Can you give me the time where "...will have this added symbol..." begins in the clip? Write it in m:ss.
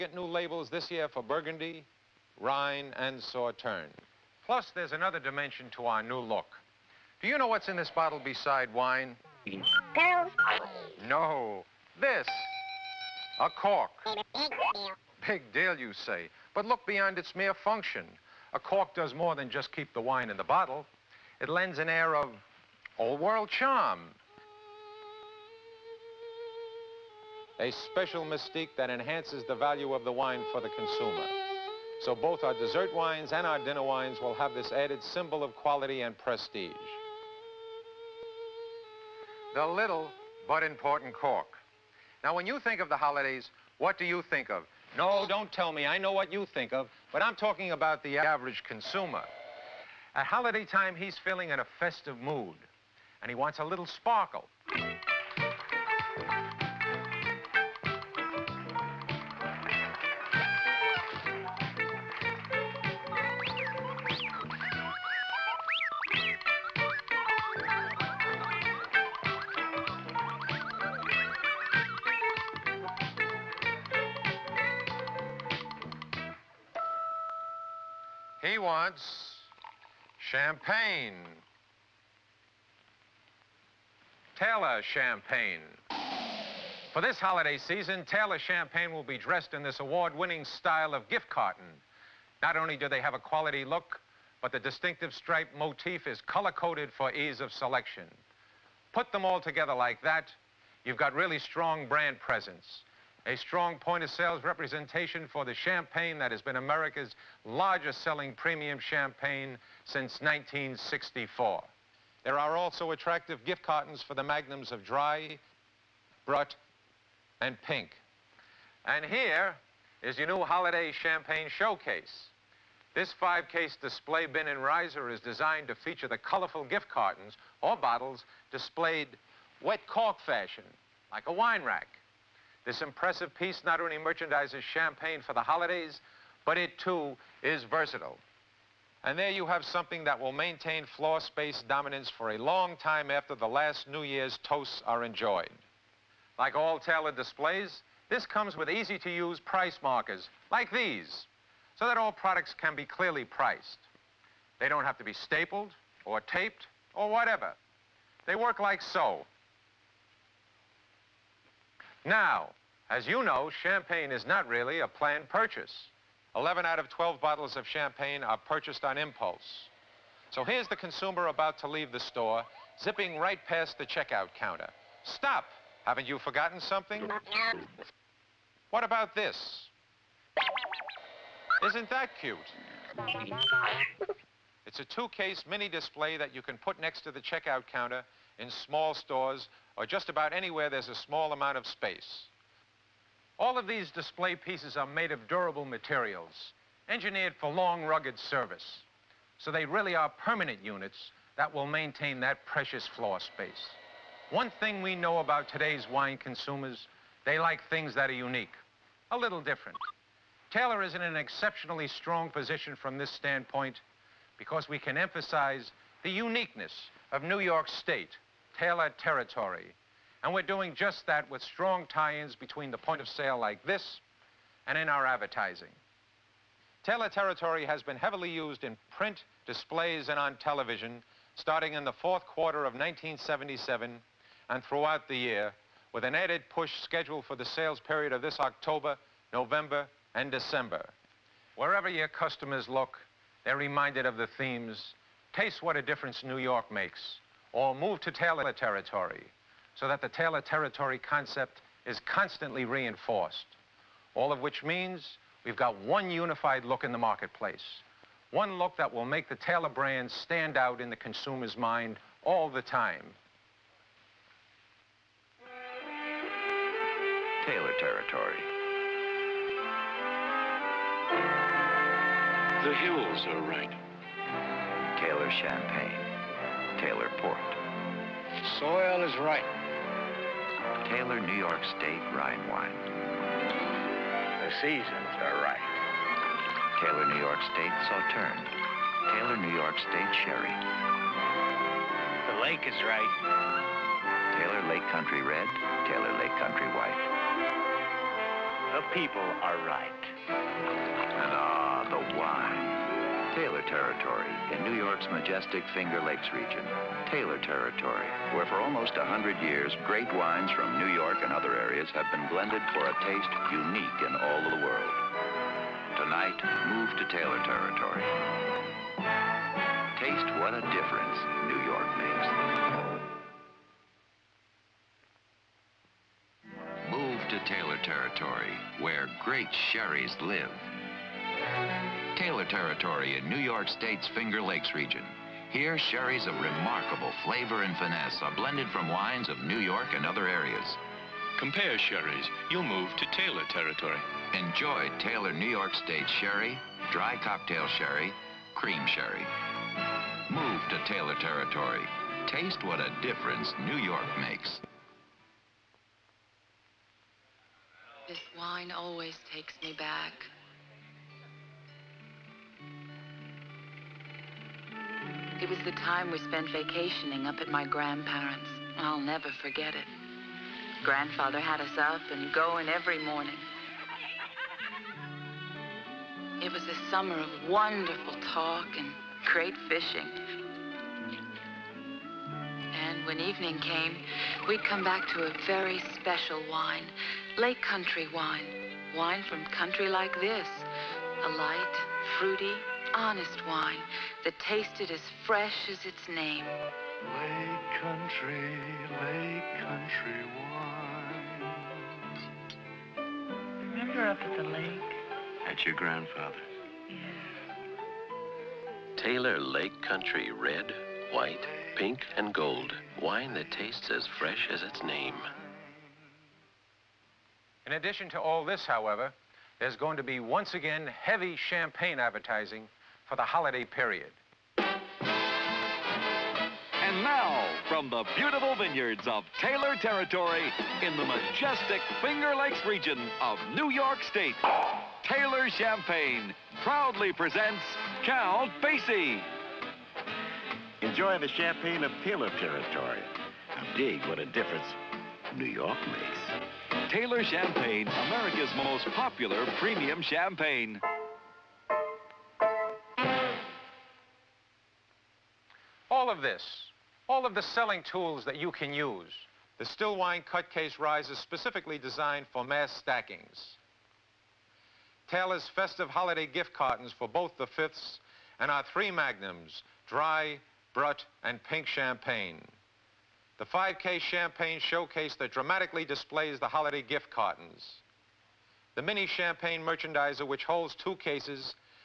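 0:34.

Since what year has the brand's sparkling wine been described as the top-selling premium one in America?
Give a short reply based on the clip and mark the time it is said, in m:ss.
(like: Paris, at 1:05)
1964, at 1:50.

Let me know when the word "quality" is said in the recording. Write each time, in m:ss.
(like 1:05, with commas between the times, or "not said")
0:35, 1:33.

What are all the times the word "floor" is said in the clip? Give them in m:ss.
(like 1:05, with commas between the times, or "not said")
2:20, 3:22.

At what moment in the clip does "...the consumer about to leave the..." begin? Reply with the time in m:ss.
2:50.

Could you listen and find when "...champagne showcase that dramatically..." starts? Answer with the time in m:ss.
7:54.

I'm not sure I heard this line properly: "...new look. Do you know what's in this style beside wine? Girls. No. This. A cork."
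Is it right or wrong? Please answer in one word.
wrong.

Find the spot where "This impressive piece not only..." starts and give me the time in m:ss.
2:12.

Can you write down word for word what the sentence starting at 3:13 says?
All of these display pieces are made of durable materials, engineered for long, rugged service.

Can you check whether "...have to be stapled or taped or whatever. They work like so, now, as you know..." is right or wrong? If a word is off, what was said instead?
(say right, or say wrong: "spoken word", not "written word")
right.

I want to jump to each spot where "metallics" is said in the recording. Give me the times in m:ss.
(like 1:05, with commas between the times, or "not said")
not said.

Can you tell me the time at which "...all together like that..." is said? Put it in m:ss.
1:39.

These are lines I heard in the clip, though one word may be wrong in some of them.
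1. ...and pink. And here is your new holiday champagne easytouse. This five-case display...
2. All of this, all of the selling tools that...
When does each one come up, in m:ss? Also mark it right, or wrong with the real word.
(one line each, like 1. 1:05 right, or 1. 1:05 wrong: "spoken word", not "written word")
1. 1:57 wrong: "showcase", not "easytouse"
2. 7:35 right.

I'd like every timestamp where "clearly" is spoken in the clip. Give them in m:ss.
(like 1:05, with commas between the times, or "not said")
2:32.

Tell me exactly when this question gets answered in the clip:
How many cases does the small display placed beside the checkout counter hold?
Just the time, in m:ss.
3:04.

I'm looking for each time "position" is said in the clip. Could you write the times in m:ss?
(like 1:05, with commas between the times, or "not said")
3:32.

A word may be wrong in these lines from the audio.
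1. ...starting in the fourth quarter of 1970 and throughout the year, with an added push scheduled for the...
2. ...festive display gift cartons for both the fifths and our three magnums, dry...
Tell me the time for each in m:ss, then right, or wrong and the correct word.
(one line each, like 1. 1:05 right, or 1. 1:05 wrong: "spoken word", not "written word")
1. 3:51 wrong: "1977", not "1970"
2. 7:45 wrong: "holiday", not "display".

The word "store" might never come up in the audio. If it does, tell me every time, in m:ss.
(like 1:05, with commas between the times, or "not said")
2:51, 3:08.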